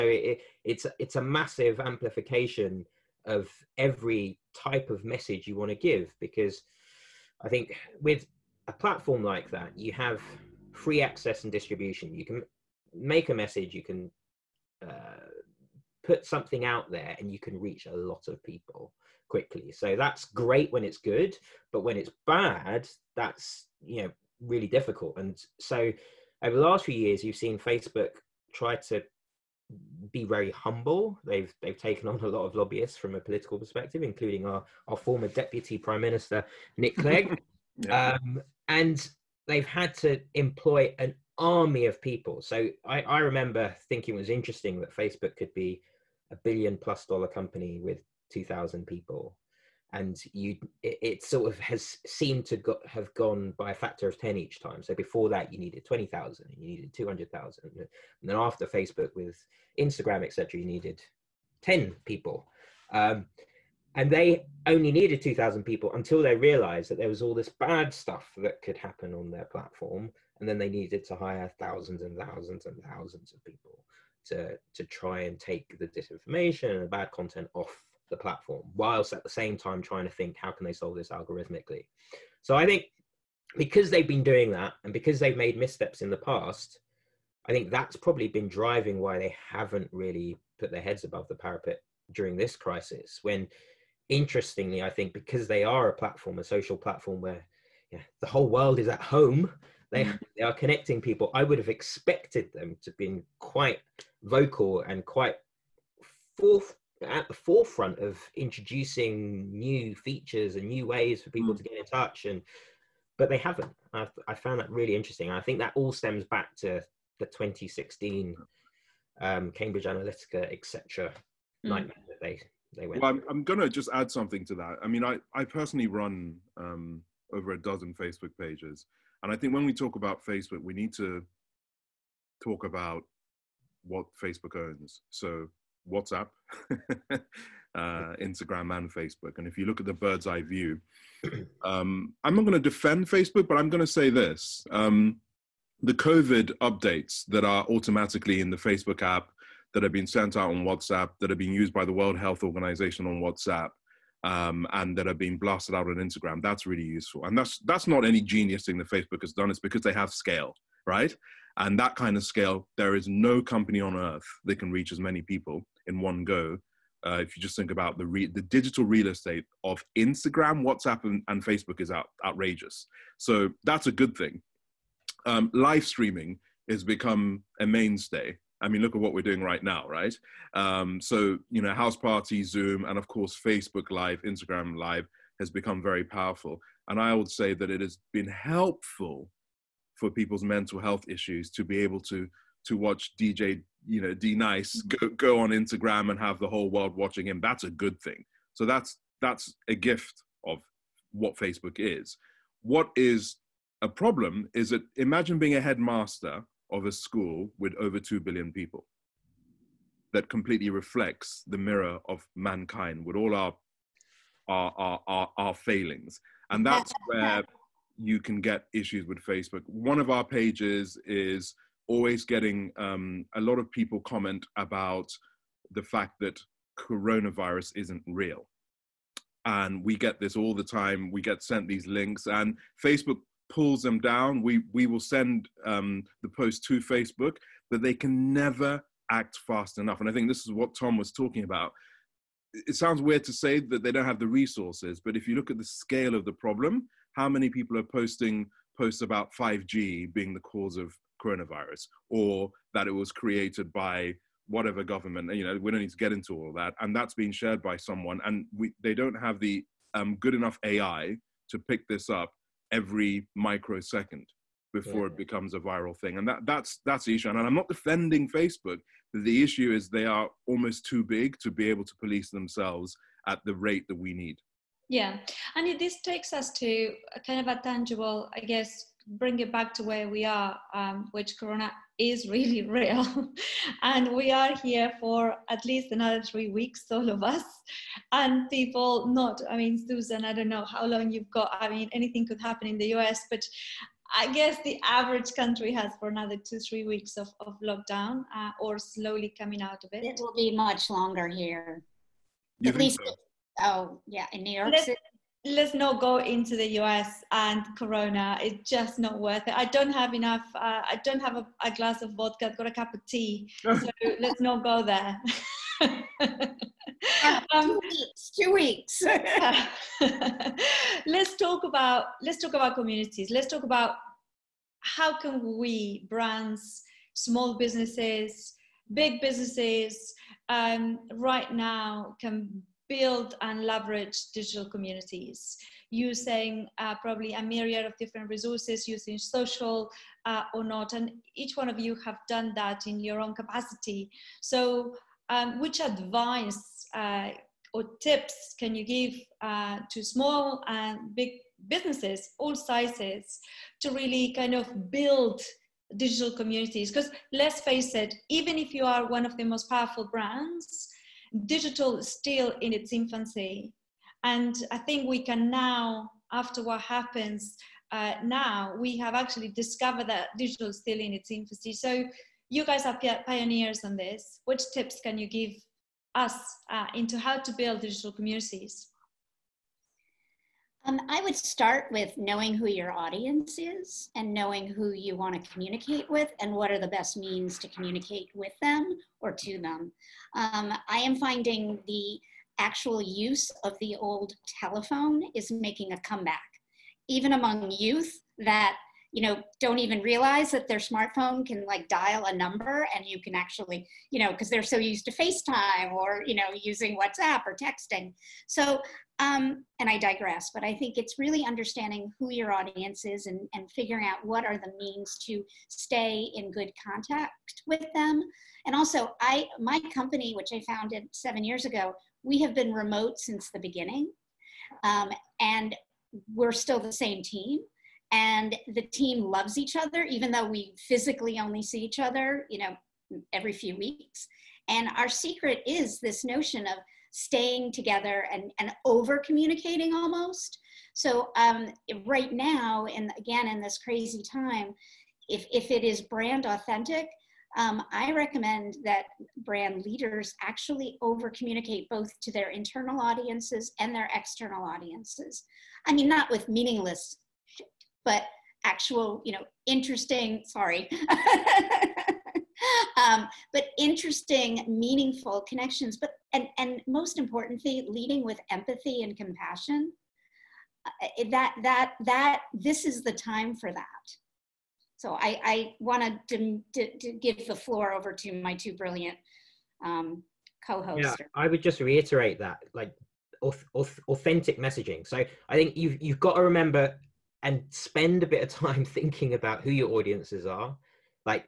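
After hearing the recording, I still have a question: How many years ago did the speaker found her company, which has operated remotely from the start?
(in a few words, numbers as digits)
7.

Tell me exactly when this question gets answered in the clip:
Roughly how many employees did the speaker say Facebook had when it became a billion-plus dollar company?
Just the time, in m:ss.
0:48.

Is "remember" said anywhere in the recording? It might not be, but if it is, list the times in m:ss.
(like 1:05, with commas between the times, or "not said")
0:43, 8:06.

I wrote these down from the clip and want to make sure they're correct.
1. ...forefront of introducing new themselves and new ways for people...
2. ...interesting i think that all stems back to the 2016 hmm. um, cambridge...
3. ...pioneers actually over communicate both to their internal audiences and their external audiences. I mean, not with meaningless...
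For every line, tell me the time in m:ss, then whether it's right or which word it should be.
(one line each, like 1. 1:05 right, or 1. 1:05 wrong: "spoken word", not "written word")
1. 1:47 wrong: "features", not "themselves"
2. 1:54 right
3. 7:29 wrong: "leaders", not "pioneers".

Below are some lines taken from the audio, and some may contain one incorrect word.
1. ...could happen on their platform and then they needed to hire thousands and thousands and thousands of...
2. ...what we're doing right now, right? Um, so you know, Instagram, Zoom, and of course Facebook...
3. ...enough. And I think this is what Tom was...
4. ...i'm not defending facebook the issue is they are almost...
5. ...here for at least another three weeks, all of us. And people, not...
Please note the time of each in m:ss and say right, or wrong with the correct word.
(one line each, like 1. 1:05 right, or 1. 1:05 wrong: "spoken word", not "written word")
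1. 1:08 right
2. 2:59 wrong: "Houseparty", not "Instagram"
3. 3:59 right
4. 4:27 right
5. 4:44 right.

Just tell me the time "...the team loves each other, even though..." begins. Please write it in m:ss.
7:08.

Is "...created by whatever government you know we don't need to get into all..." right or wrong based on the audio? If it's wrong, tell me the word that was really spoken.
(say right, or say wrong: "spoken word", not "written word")
right.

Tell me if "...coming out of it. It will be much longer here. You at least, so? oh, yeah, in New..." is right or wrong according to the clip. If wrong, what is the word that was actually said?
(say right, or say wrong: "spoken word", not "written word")
right.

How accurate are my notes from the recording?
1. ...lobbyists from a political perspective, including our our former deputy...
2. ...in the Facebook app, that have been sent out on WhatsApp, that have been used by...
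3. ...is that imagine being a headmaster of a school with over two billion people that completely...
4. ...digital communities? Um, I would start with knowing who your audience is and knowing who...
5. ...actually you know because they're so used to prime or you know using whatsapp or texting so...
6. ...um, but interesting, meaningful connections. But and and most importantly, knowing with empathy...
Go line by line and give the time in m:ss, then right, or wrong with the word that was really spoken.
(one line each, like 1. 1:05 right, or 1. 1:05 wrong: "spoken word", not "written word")
1. 0:32 right
2. 2:28 right
3. 3:24 right
4. 6:17 right
5. 6:43 wrong: "facetime", not "prime"
6. 7:42 wrong: "leading", not "knowing".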